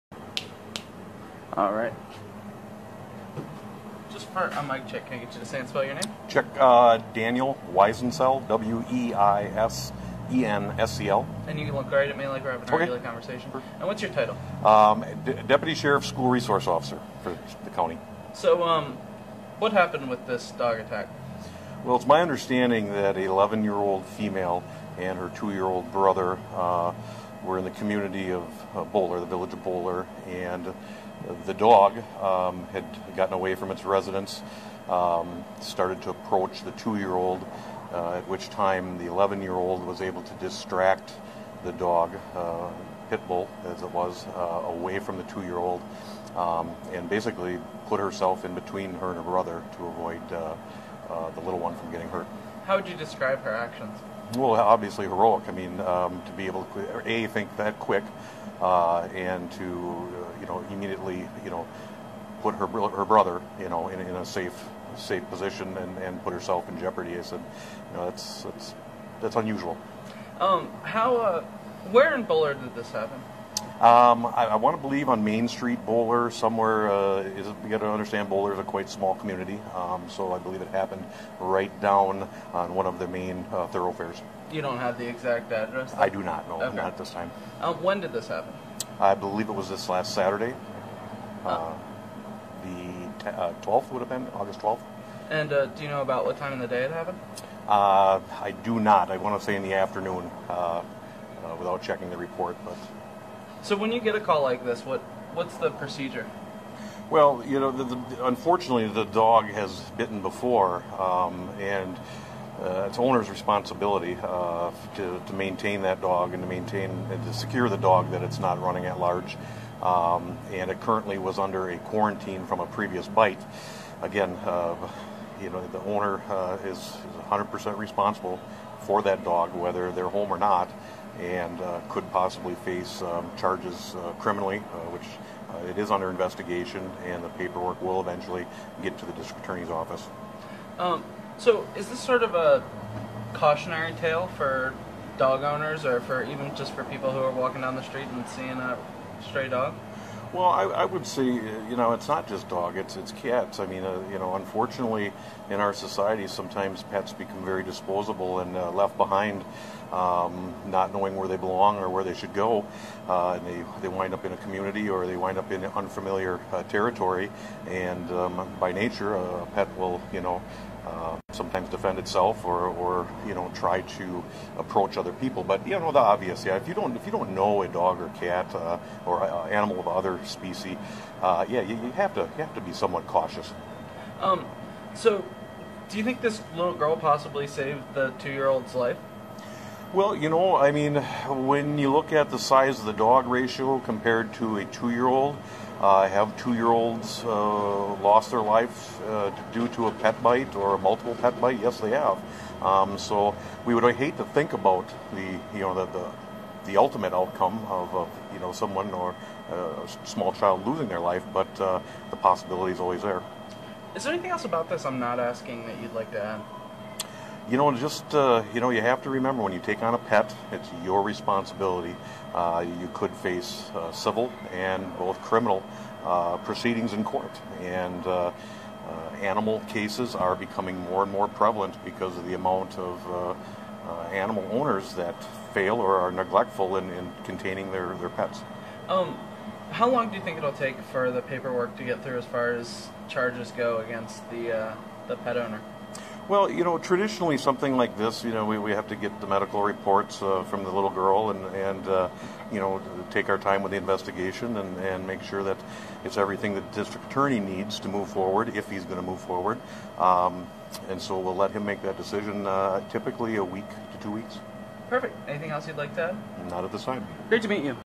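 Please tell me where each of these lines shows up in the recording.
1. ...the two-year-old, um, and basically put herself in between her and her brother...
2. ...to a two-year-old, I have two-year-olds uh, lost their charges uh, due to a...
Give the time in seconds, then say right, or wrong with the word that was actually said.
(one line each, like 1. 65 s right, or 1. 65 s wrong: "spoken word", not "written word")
1. 45 s right
2. 194 s wrong: "lives", not "charges".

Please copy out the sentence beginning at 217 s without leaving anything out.
you know, just uh, you know, you have to remember when you take on a pet, it's your responsibility.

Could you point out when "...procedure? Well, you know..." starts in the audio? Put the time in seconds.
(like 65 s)
105 s.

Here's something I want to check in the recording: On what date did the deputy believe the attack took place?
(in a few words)
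August 12.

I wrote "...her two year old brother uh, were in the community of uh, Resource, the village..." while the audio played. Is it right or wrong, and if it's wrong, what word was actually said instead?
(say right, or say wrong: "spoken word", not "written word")
wrong: "Bowler", not "Resource".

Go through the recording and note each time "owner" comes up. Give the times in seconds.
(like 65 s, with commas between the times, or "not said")
112 s, 125 s, 145 s, 234 s, 245 s.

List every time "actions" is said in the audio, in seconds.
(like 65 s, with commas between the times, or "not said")
53 s.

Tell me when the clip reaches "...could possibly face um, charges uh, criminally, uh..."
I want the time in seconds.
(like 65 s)
131 s.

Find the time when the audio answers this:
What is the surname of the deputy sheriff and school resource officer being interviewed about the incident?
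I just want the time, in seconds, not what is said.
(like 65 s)
7 s.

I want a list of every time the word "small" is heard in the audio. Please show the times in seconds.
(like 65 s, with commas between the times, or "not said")
78 s, 210 s.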